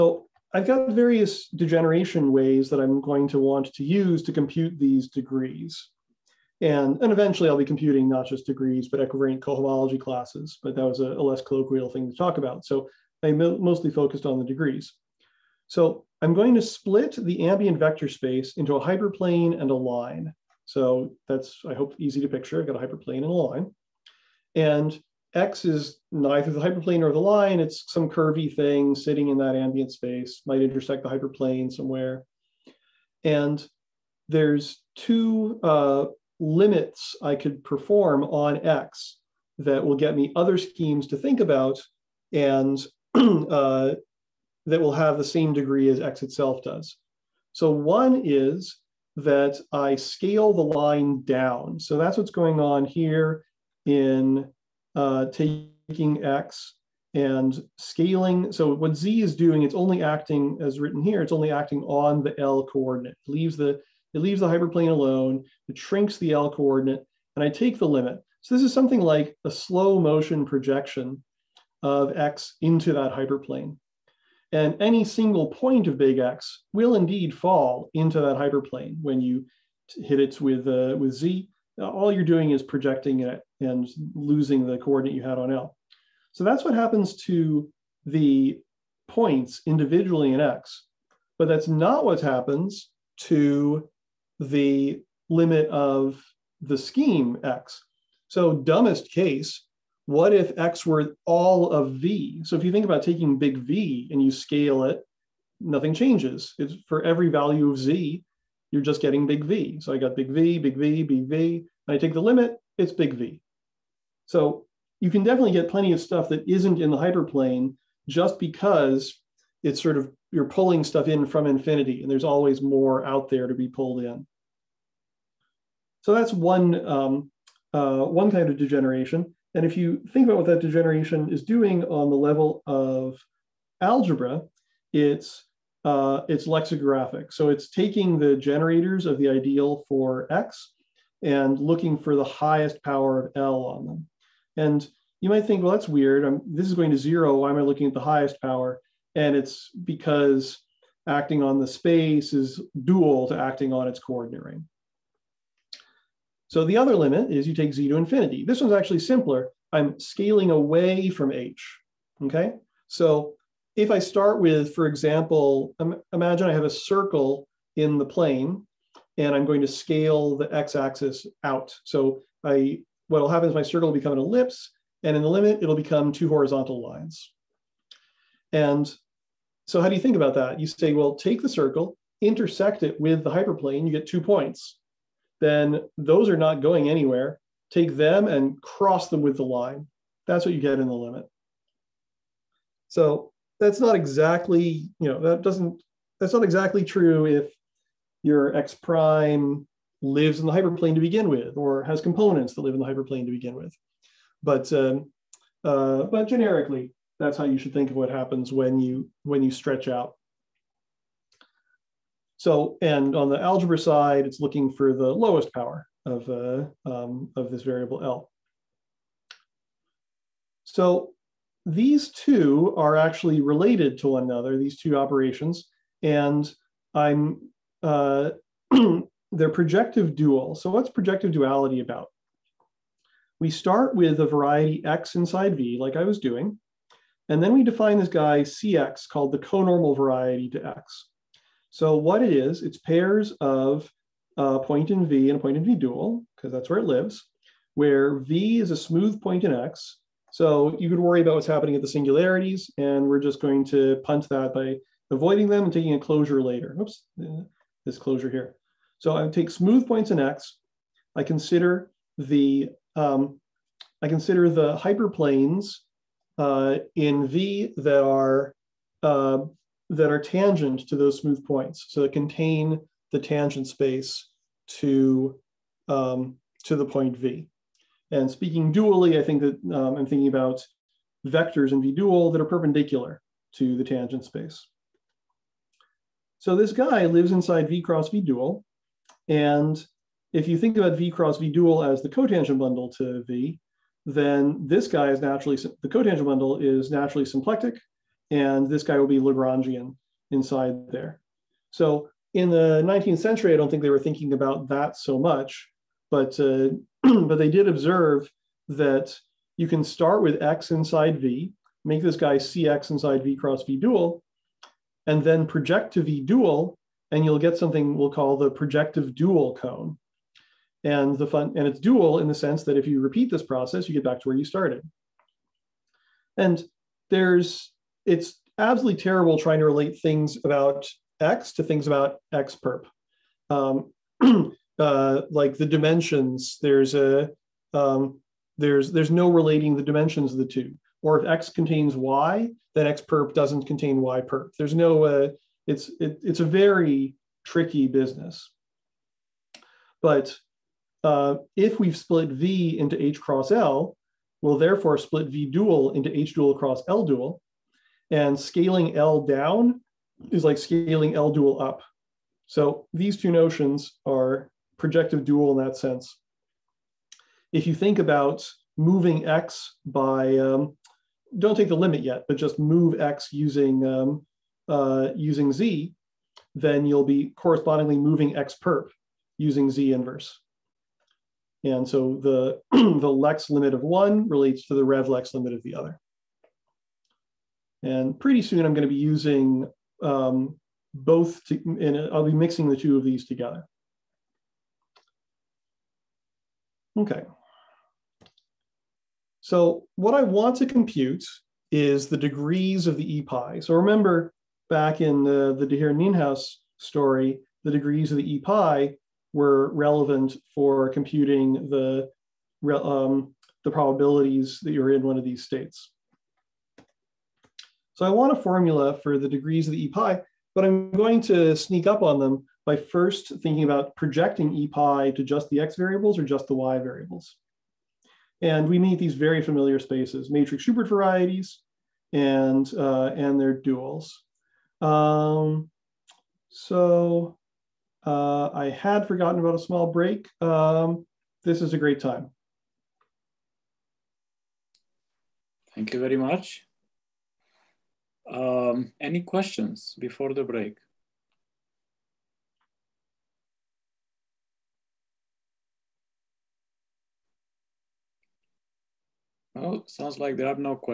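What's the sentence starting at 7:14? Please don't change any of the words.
Um, so uh, I had forgotten about a small break.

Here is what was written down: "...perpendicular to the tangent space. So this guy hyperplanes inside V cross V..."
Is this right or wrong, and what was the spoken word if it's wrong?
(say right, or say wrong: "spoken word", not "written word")
wrong: "lives", not "hyperplanes".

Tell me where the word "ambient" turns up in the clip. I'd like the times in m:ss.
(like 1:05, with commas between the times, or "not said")
0:17, 0:29.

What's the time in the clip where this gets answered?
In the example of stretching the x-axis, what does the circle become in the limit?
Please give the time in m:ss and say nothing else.
2:56.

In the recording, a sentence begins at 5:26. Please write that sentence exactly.
And there's it's absolutely terrible trying to relate things about x to things about x perp.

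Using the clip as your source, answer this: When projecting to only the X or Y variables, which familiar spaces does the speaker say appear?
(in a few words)
Matrix Schubert varieties.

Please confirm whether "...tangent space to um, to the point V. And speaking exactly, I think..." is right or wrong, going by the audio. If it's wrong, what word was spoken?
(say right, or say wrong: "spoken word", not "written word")
wrong: "dually", not "exactly".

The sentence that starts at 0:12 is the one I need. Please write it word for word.
So I mostly focused on the degrees.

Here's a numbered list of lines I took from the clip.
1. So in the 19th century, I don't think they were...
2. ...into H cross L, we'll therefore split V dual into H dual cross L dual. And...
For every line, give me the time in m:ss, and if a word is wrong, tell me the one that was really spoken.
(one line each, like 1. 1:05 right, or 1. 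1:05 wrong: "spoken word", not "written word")
1. 5:01 right
2. 5:52 right.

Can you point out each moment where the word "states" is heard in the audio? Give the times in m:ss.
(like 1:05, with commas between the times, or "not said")
6:55.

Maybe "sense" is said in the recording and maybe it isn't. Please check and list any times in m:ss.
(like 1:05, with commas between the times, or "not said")
5:22, 6:05.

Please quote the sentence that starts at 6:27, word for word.
And pretty soon I'm going to be using um, both, to, and I'll be mixing the two of these together.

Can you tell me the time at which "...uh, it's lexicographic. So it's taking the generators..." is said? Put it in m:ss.
2:15.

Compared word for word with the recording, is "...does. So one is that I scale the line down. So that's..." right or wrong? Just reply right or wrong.
right.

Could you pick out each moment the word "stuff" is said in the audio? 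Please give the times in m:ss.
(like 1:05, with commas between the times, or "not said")
1:55, 2:00.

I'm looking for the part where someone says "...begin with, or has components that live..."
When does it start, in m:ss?
3:20.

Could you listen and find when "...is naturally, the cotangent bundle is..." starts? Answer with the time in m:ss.
4:55.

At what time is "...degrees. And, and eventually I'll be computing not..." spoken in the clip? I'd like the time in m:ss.
0:05.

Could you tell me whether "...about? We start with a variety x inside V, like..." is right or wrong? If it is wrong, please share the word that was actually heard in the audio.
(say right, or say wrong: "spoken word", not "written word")
right.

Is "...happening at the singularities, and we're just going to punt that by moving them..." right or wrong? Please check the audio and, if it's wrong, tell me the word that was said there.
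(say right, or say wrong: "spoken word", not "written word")
wrong: "avoiding", not "moving".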